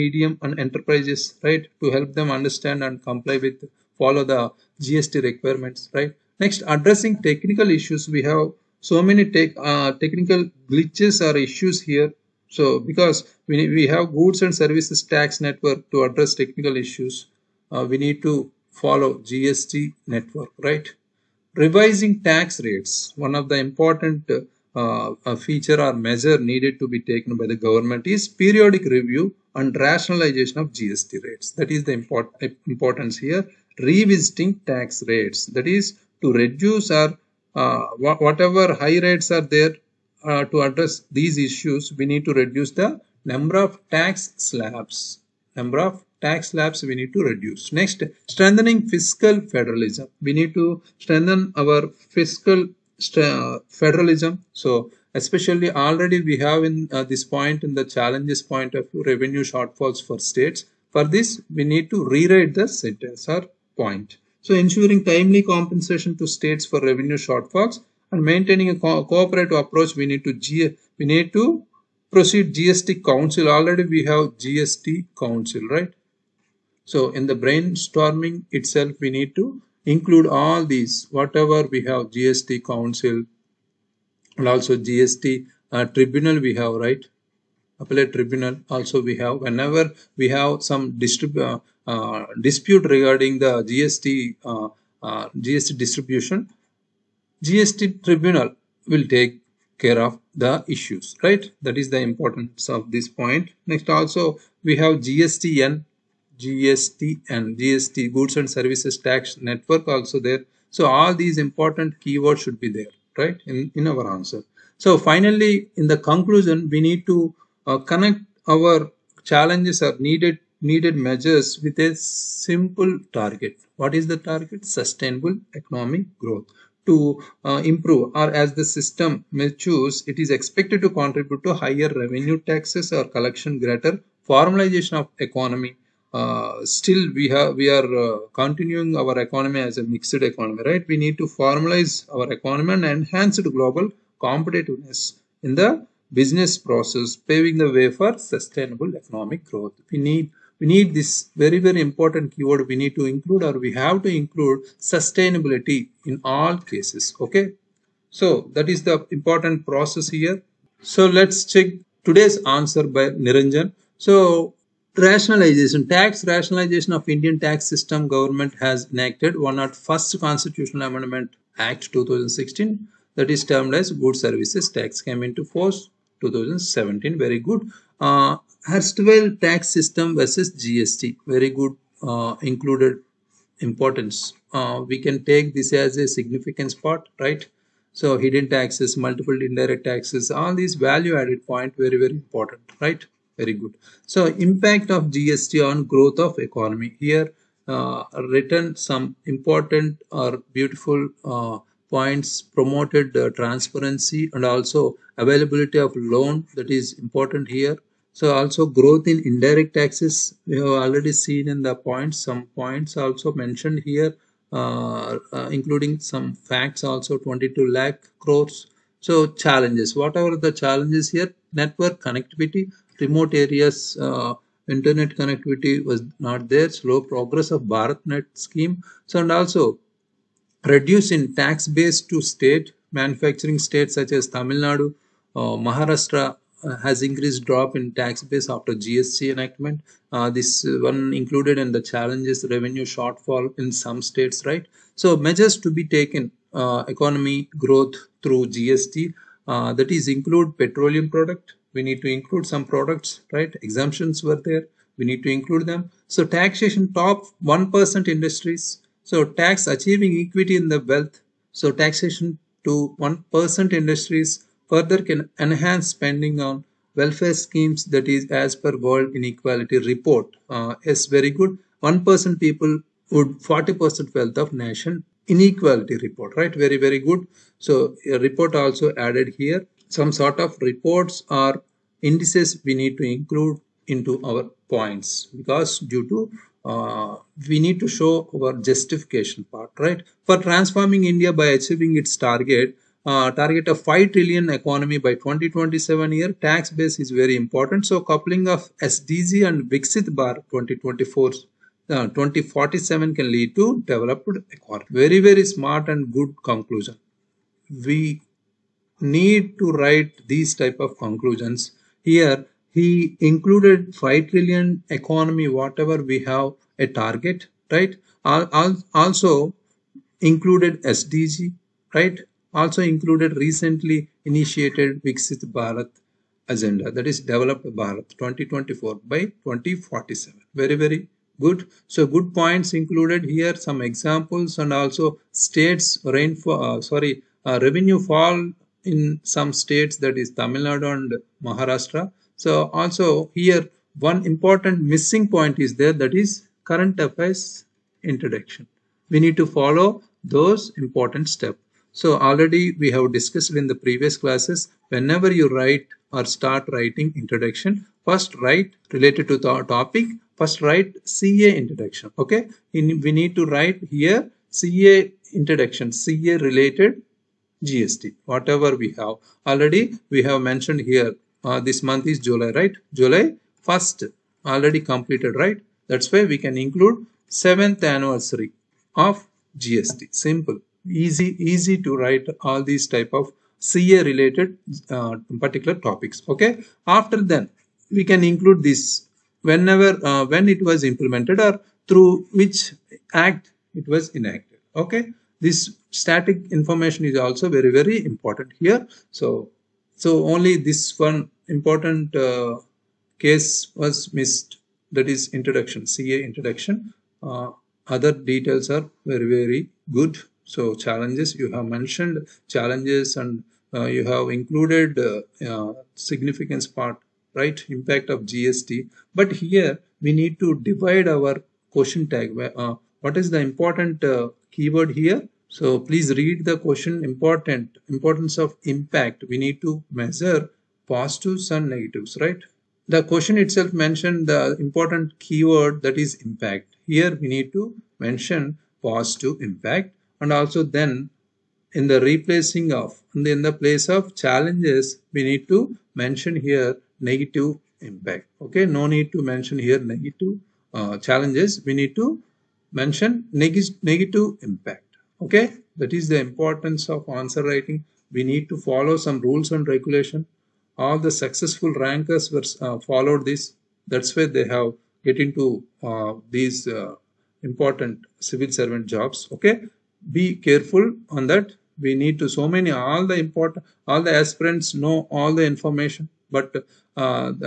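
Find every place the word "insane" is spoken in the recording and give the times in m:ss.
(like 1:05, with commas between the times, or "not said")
not said.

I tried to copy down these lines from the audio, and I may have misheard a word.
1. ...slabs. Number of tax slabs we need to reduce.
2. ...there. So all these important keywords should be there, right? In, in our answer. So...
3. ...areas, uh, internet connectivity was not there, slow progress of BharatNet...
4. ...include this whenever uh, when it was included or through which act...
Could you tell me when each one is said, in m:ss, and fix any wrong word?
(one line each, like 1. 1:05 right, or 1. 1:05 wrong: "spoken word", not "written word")
1. 0:44 right
2. 1:50 right
3. 3:43 right
4. 6:28 wrong: "implemented", not "included".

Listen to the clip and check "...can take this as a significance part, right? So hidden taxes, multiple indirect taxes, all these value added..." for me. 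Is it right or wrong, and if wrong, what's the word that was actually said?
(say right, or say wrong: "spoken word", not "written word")
right.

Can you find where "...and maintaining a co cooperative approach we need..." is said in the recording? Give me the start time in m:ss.
1:08.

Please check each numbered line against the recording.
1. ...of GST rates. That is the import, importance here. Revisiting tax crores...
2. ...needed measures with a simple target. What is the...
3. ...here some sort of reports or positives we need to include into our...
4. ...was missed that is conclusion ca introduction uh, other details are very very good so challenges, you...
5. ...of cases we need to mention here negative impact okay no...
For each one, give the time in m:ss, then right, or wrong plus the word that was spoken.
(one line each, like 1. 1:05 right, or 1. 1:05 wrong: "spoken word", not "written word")
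1. 0:30 wrong: "rates", not "crores"
2. 2:00 right
3. 4:39 wrong: "indices", not "positives"
4. 6:43 wrong: "introduction", not "conclusion"
5. 7:23 wrong: "challenges", not "cases".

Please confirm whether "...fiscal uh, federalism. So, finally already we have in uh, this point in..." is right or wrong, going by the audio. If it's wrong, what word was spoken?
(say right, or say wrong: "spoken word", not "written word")
wrong: "especially", not "finally".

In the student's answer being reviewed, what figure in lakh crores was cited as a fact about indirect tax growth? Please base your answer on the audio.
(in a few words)
22 lakh crores.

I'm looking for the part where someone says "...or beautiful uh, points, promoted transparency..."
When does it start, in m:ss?
3:20.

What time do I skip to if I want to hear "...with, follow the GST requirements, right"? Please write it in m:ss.
0:03.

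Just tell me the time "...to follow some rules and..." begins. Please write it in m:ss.
7:38.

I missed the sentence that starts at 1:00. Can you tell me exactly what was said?
For this, we need to rewrite the sentence or point.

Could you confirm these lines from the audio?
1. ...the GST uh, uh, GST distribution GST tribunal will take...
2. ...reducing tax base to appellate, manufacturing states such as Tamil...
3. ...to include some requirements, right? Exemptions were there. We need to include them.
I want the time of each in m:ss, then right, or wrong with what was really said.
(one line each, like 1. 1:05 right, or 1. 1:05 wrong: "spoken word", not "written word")
1. 1:33 right
2. 3:50 wrong: "state", not "appellate"
3. 4:12 wrong: "products", not "requirements".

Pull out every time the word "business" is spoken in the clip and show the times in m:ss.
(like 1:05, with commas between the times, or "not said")
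2:26.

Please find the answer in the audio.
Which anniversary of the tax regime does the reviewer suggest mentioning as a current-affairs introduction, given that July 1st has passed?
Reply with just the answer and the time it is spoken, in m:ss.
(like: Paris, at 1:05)
7th anniversary, at 6:17.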